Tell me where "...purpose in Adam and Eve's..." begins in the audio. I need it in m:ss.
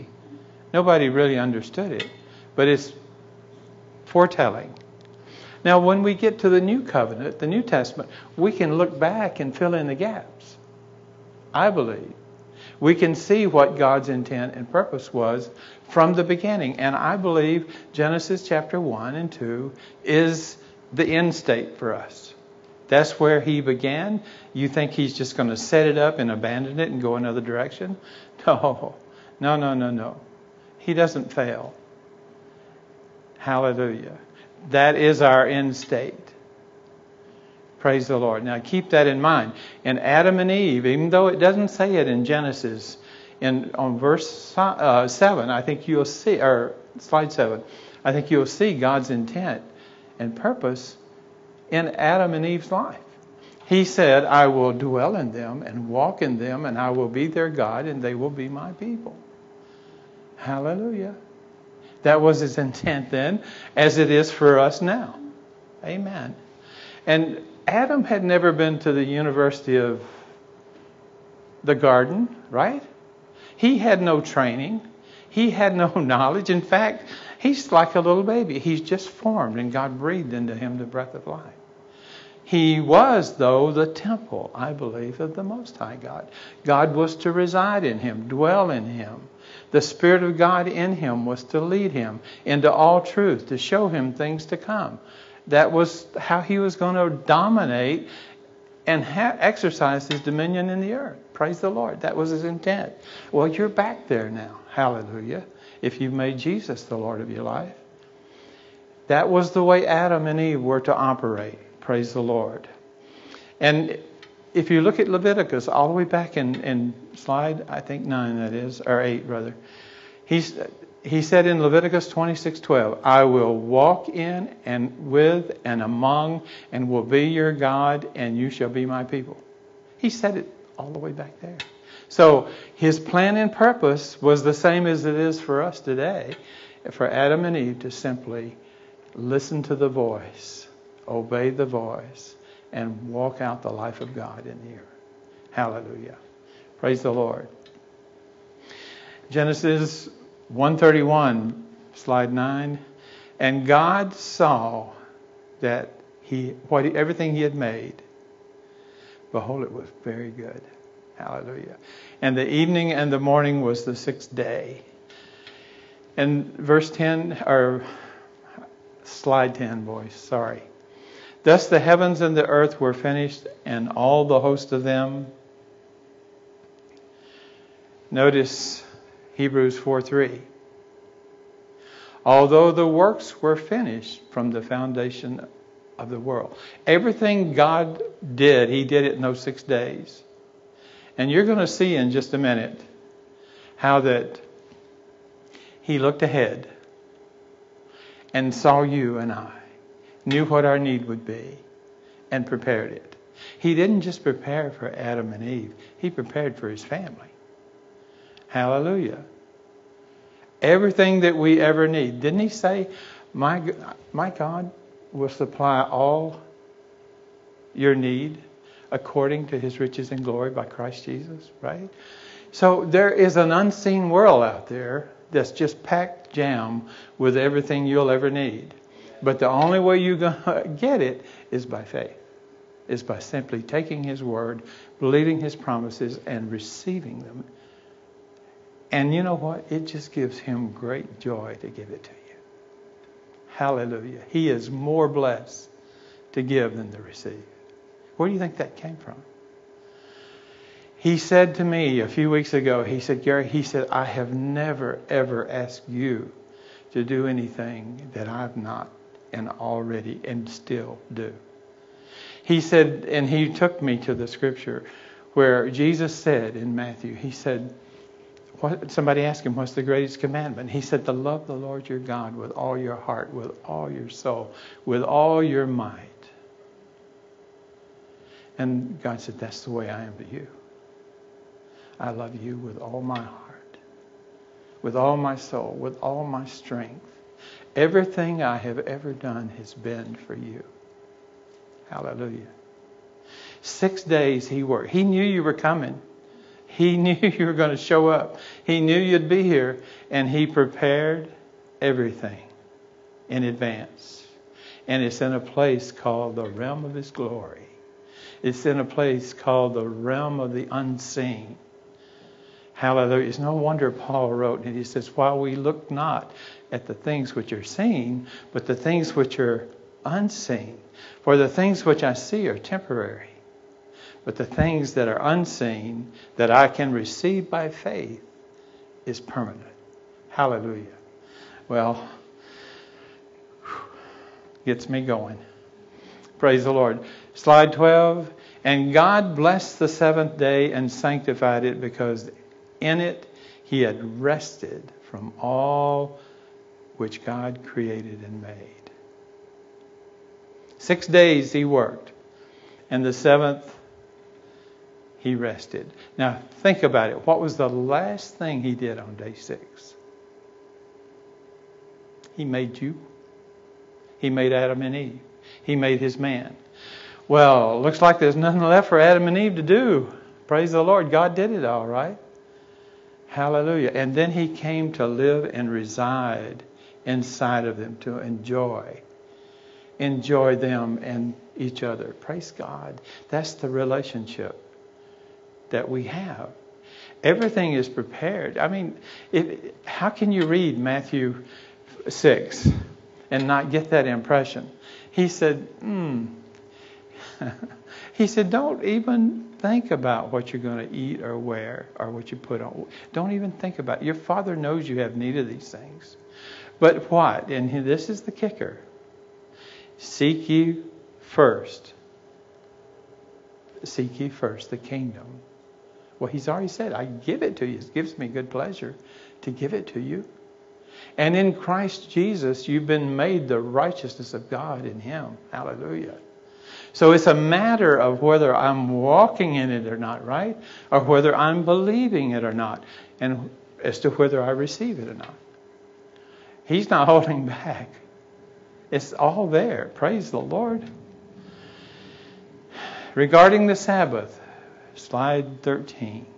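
0:50.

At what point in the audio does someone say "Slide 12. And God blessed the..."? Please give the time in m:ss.
5:37.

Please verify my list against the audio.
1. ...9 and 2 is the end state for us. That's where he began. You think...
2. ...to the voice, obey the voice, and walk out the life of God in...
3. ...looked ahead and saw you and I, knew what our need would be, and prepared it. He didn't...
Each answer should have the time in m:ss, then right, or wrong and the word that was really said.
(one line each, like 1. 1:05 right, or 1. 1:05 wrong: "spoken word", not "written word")
1. 0:18 wrong: "1", not "9"
2. 2:19 right
3. 3:15 right.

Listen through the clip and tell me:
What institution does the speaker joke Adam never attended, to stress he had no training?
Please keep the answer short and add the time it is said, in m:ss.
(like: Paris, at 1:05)
University of the Garden, at 1:09.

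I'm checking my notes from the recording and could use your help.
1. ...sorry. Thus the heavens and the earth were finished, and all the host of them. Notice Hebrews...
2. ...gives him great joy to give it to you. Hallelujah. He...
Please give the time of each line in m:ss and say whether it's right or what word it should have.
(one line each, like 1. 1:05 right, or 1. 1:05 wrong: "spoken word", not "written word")
1. 2:50 right
2. 4:00 right.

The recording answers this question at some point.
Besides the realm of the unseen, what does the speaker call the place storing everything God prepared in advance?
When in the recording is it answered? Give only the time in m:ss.
5:06.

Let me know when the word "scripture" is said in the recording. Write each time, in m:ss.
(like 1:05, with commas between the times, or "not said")
4:24.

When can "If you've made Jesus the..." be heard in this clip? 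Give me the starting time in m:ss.
1:45.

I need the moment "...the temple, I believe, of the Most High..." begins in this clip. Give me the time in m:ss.
1:23.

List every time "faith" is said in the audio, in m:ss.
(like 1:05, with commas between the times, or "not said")
3:51, 5:27.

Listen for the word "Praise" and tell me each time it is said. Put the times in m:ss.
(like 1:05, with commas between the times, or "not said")
0:37, 1:41, 1:51, 2:26, 5:36, 6:10, 6:22, 7:19.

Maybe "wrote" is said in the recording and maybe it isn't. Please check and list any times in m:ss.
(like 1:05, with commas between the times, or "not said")
5:14.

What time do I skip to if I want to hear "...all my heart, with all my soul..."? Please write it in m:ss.
4:42.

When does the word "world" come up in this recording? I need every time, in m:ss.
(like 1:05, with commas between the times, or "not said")
3:06, 3:44.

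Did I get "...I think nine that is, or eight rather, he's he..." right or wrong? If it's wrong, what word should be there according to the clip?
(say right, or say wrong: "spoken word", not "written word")
right.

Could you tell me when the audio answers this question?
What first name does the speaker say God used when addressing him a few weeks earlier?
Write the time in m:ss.
4:13.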